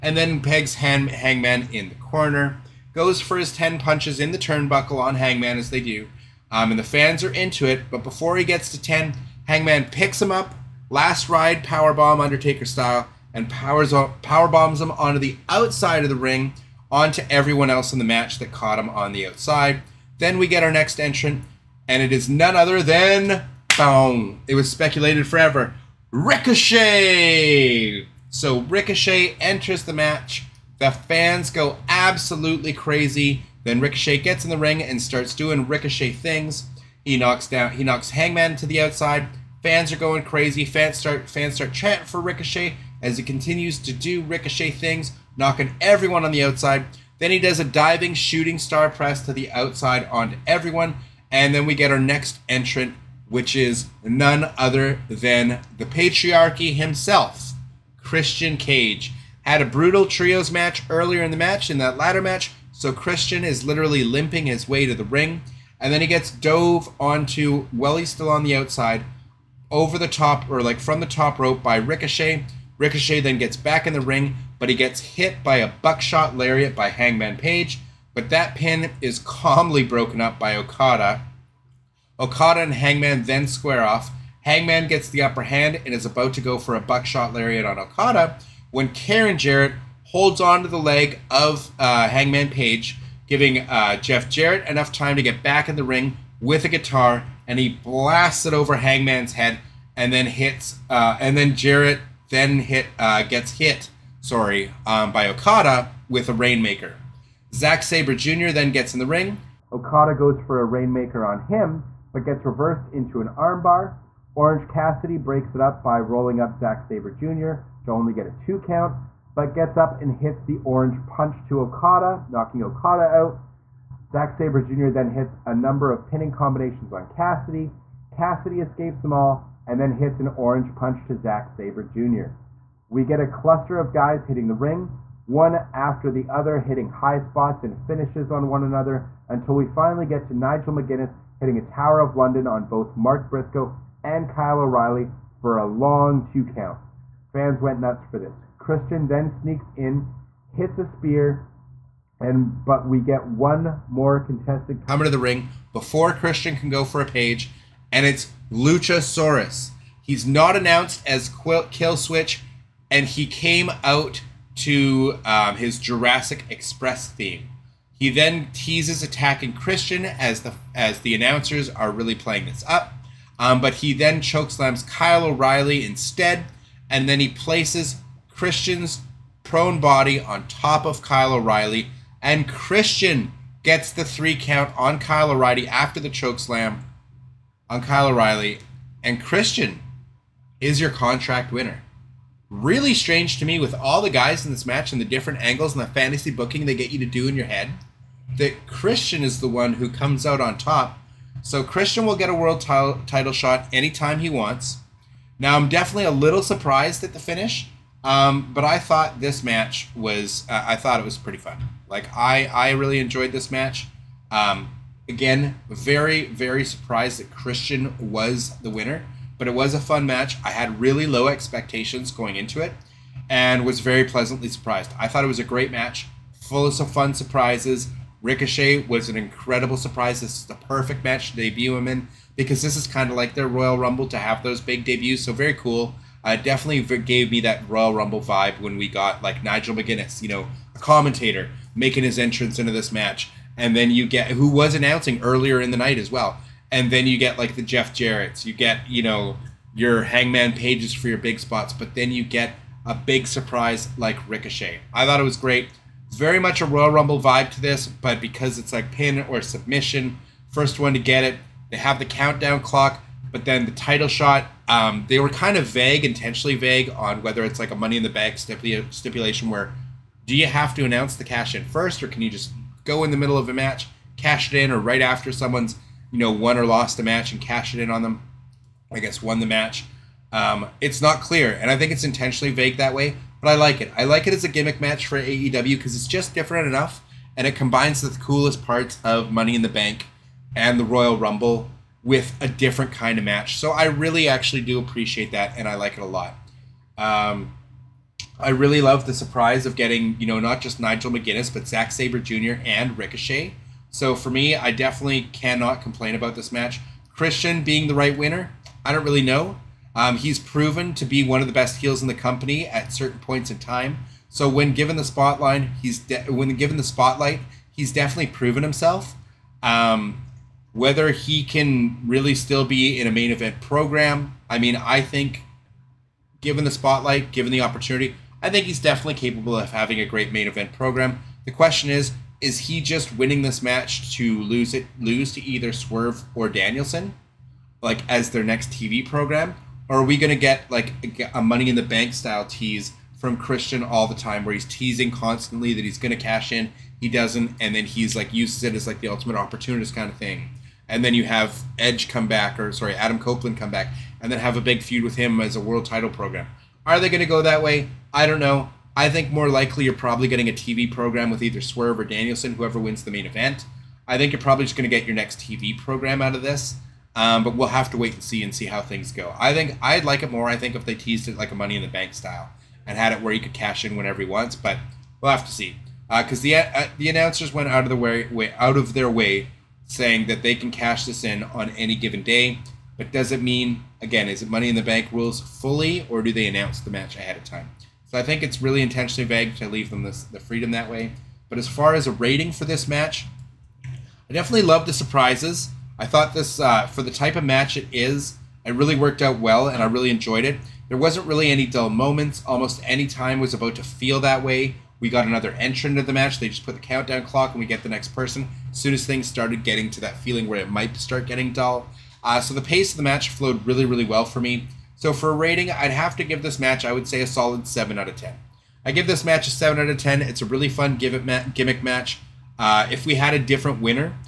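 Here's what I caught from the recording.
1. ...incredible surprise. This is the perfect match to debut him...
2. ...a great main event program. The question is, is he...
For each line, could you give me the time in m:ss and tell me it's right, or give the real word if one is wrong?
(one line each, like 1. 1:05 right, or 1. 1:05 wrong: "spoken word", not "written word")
1. 3:49 right
2. 5:29 right.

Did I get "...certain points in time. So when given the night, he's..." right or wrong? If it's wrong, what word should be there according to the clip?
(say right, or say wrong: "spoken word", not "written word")
wrong: "spotlight", not "night".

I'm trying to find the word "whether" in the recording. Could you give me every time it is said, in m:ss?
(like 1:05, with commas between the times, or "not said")
4:27, 5:20.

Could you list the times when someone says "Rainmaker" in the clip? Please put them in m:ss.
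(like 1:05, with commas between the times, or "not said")
1:46, 1:50.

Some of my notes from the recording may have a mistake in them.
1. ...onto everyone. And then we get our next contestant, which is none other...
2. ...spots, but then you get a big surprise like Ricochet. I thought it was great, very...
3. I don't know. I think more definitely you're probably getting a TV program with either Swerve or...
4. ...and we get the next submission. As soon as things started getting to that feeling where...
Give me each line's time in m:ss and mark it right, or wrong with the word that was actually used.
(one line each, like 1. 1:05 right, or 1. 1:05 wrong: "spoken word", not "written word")
1. 0:50 wrong: "entrant", not "contestant"
2. 4:11 right
3. 5:58 wrong: "likely", not "definitely"
4. 6:47 wrong: "person", not "submission".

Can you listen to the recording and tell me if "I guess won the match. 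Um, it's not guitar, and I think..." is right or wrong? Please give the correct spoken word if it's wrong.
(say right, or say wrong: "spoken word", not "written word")
wrong: "clear", not "guitar".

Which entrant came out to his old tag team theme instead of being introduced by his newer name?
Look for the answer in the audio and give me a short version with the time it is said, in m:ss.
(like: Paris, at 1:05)
Luchasaurus, at 2:38.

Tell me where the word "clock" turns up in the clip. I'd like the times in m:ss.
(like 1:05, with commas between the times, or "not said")
4:22, 6:47.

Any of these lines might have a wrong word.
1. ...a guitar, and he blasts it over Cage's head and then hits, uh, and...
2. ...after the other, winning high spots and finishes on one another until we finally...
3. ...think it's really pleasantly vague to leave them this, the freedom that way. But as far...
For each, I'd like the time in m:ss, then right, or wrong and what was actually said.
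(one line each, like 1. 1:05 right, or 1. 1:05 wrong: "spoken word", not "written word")
1. 1:36 wrong: "Hangman", not "Cage"
2. 2:15 wrong: "hitting", not "winning"
3. 6:28 wrong: "intentionally", not "pleasantly".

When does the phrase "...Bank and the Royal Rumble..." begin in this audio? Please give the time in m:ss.
4:49.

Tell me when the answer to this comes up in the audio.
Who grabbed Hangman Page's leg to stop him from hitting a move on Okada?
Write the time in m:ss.
1:28.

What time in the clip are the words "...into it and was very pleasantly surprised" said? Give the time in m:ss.
3:42.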